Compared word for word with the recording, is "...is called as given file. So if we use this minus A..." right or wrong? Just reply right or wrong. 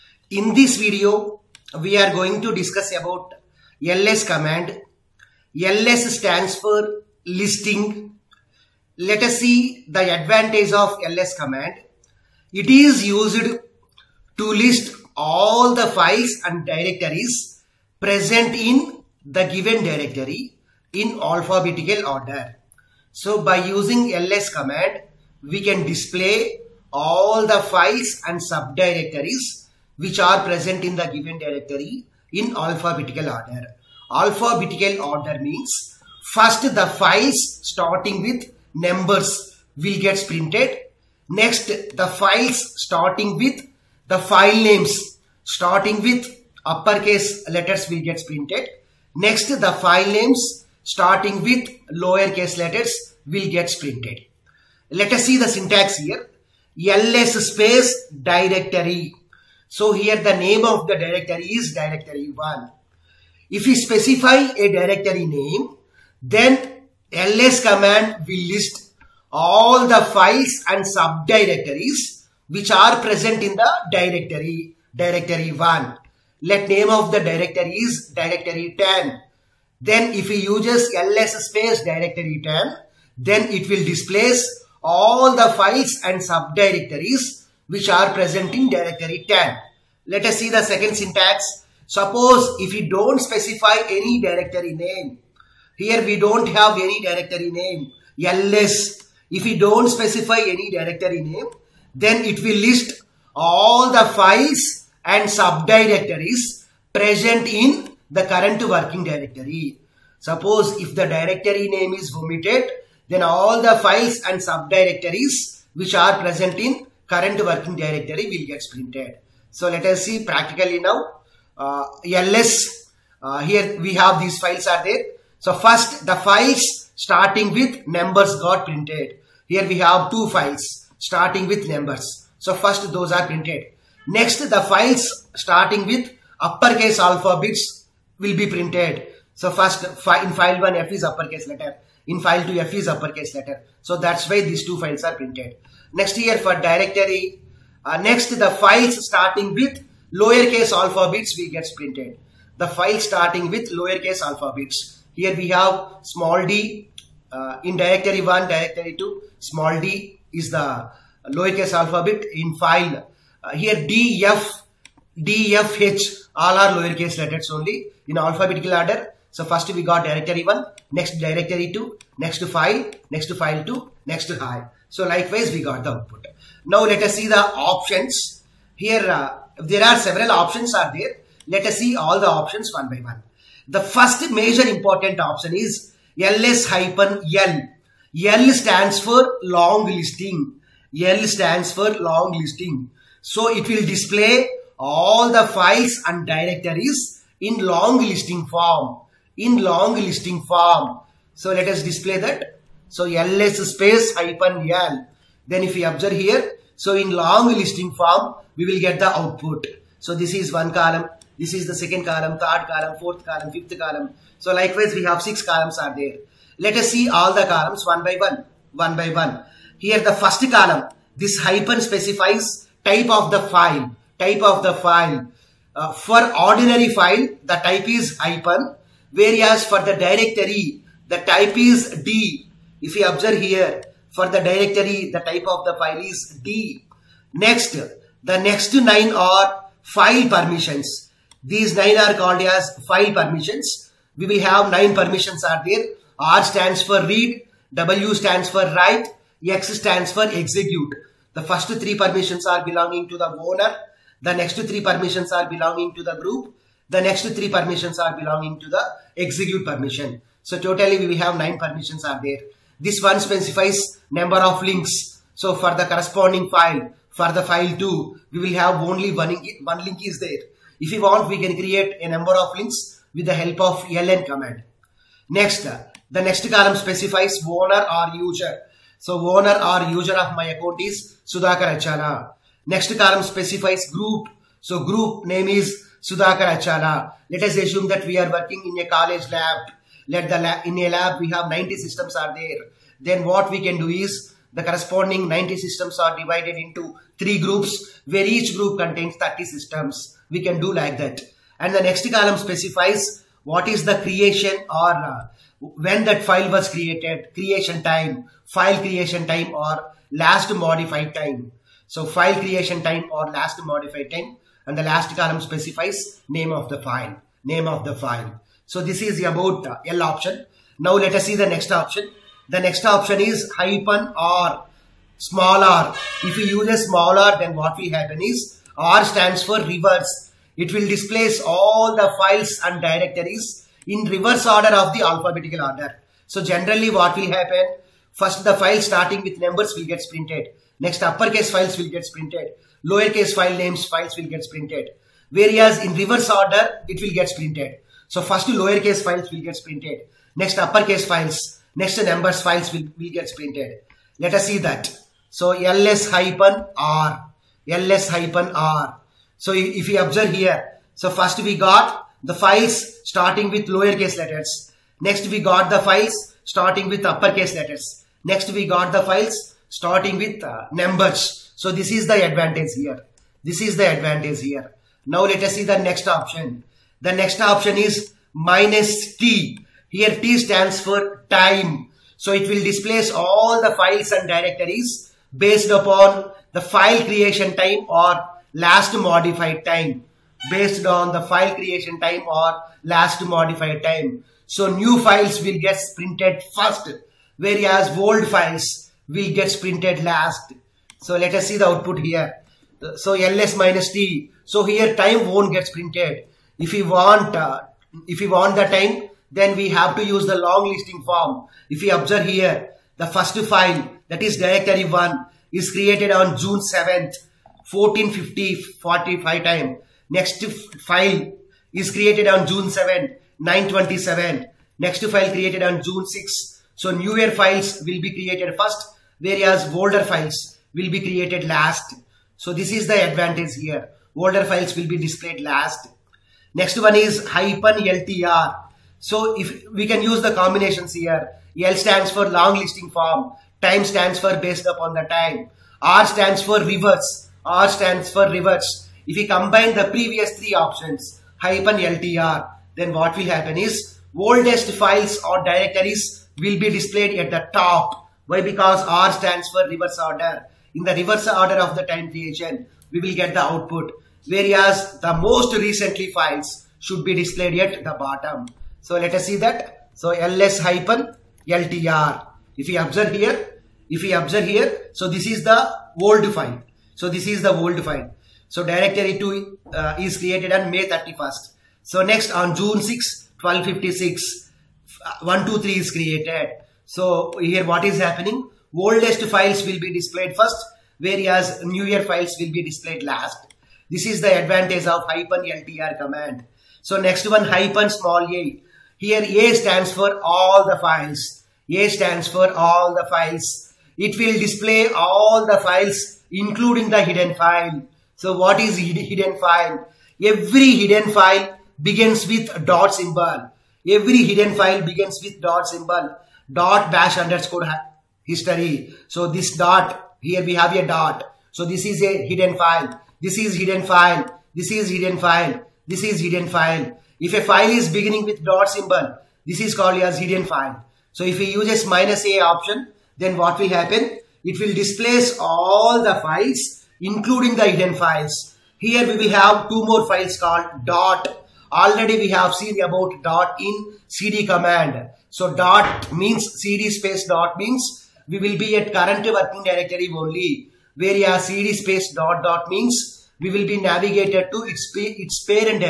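wrong.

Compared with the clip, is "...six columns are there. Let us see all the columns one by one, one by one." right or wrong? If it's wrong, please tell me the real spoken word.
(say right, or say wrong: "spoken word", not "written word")
right.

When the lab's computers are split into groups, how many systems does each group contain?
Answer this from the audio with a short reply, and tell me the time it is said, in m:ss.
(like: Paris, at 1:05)
30, at 4:59.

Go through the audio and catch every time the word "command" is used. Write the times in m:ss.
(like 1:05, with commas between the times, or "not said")
0:04, 0:11, 0:24, 1:07, 4:34, 8:15, 9:04.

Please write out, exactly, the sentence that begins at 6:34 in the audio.
So new files will get printed first whereas old files will get printed last.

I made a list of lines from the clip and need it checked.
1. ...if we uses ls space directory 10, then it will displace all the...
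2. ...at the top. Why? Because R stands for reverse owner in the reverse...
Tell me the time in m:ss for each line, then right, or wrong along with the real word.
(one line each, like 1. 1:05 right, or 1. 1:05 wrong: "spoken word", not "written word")
1. 1:20 right
2. 7:37 wrong: "order", not "owner".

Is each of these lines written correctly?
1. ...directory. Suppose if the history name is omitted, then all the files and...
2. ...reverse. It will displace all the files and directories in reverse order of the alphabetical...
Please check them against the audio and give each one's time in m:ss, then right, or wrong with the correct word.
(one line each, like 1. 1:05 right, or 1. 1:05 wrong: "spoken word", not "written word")
1. 1:49 wrong: "directory", not "history"
2. 5:29 right.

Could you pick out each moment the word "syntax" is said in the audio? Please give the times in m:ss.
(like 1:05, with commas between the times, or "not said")
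0:55, 1:30.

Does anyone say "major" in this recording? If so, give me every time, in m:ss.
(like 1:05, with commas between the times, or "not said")
3:04.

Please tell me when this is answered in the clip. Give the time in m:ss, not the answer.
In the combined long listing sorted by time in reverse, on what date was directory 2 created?
8:00.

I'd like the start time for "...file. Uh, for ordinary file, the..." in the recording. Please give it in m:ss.
3:44.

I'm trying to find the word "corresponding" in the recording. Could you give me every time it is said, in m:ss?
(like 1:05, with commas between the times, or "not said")
4:25, 4:54.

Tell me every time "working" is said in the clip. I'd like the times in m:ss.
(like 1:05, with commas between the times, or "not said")
1:48, 1:57, 4:48, 9:09.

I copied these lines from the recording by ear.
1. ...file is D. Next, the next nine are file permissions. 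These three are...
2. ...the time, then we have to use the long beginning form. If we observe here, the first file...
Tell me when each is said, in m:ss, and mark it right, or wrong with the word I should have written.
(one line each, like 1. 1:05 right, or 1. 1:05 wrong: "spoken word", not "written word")
1. 3:55 wrong: "nine", not "three"
2. 6:48 wrong: "listing", not "beginning".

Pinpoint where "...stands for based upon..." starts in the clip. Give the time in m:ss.
7:23.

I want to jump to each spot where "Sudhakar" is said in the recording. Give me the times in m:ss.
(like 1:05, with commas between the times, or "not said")
4:41, 4:46.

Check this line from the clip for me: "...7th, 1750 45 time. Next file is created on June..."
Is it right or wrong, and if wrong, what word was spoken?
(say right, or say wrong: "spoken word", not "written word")
wrong: "1450", not "1750".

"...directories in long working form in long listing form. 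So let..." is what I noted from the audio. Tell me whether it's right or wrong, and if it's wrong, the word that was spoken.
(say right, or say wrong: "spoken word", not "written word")
wrong: "listing", not "working".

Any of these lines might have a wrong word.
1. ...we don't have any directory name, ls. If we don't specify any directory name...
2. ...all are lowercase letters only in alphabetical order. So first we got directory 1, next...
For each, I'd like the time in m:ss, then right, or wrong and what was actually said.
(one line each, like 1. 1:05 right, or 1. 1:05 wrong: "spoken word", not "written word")
1. 1:36 right
2. 2:46 right.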